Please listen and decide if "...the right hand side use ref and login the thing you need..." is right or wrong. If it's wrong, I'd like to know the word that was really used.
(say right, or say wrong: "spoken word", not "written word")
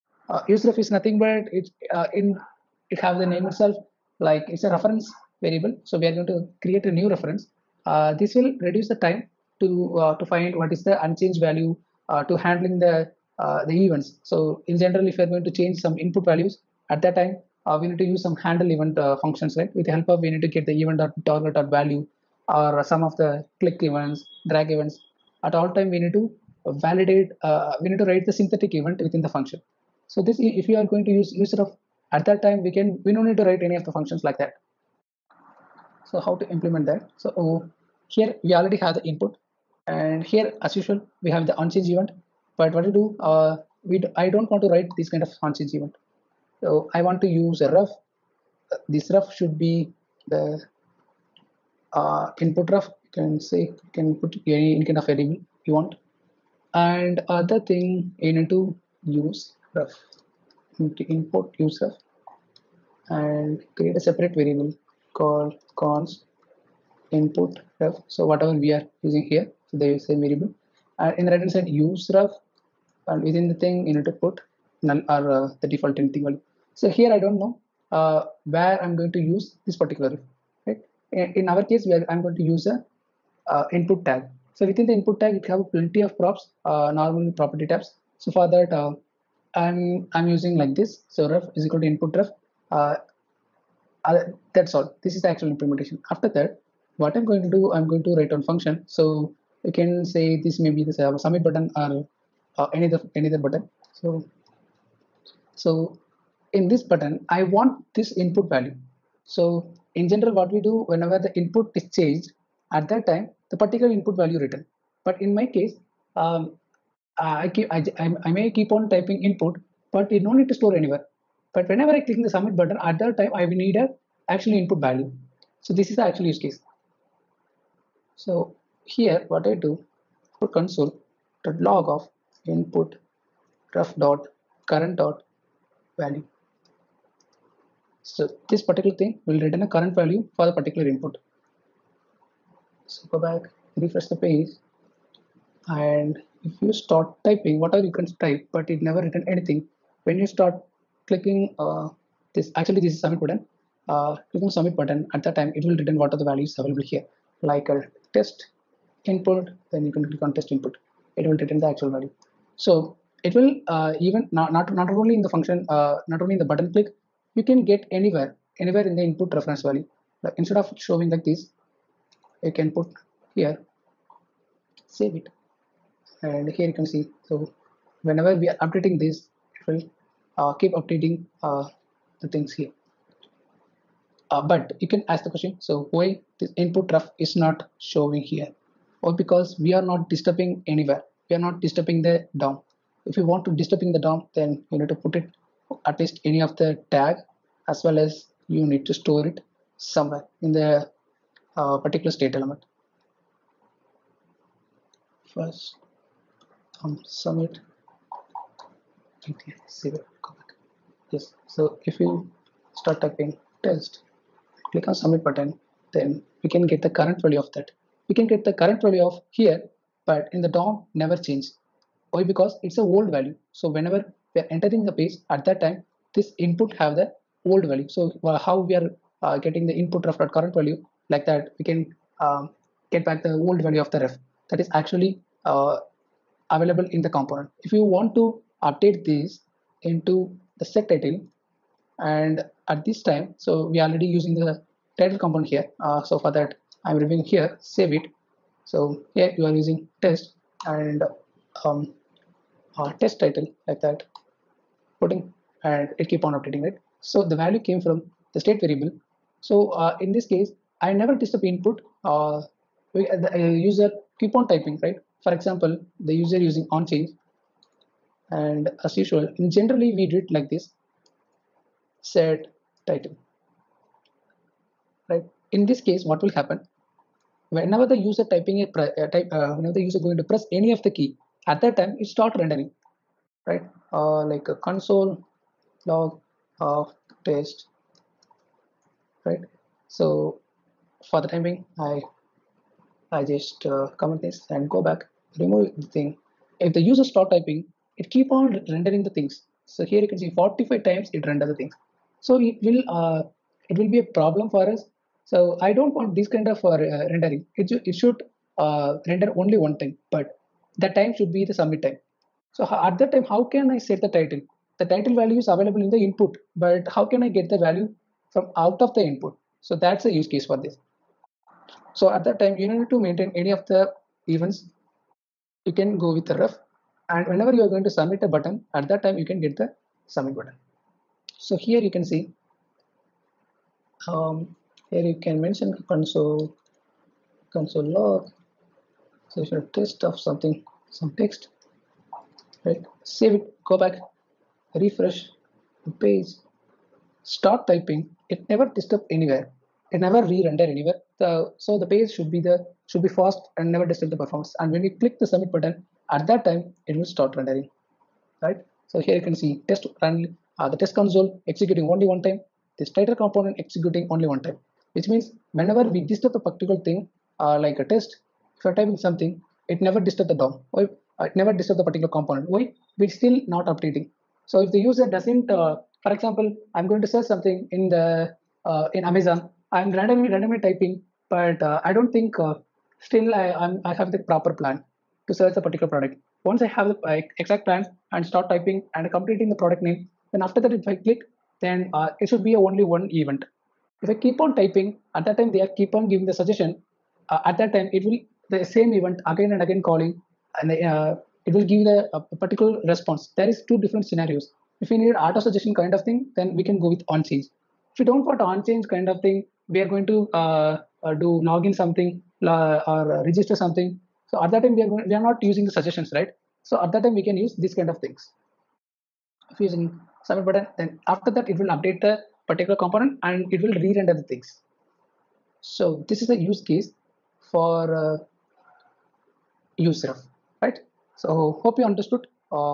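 wrong: "within", not "login".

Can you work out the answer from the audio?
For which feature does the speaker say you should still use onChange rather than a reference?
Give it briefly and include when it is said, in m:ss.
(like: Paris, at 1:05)
auto suggestion, at 6:45.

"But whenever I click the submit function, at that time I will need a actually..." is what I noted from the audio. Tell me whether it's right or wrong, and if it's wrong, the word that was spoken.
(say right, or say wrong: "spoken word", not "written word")
wrong: "button", not "function".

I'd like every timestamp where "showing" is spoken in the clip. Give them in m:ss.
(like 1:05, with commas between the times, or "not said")
2:50, 3:07.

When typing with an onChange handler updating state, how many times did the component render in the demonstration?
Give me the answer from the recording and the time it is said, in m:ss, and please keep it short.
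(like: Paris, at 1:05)
45, at 5:00.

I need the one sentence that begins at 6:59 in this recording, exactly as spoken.
If using submit button, then after that it will update the particular component and it will re-render the things.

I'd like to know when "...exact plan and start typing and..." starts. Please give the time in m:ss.
6:27.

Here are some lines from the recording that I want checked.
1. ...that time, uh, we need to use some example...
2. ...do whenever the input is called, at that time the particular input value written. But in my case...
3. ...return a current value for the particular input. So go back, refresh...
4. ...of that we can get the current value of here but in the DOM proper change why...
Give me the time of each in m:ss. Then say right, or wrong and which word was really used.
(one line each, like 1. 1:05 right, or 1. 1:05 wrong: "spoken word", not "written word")
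1. 0:17 wrong: "handle", not "example"
2. 1:50 wrong: "changed", not "called"
3. 2:19 right
4. 3:37 wrong: "never", not "proper".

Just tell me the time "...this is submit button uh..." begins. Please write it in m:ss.
2:32.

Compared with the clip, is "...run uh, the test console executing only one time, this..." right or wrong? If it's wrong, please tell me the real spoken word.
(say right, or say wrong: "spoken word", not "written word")
right.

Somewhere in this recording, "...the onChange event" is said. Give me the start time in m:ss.
0:41.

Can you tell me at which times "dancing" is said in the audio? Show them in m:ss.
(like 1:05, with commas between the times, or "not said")
not said.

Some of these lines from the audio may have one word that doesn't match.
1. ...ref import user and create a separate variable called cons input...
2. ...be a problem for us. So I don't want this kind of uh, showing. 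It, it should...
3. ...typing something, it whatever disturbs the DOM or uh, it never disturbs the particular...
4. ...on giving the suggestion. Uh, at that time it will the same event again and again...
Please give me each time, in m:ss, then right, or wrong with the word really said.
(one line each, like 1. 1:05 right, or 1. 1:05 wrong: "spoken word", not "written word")
1. 0:59 right
2. 5:03 wrong: "rendering", not "showing"
3. 6:08 wrong: "never", not "whatever"
4. 6:35 right.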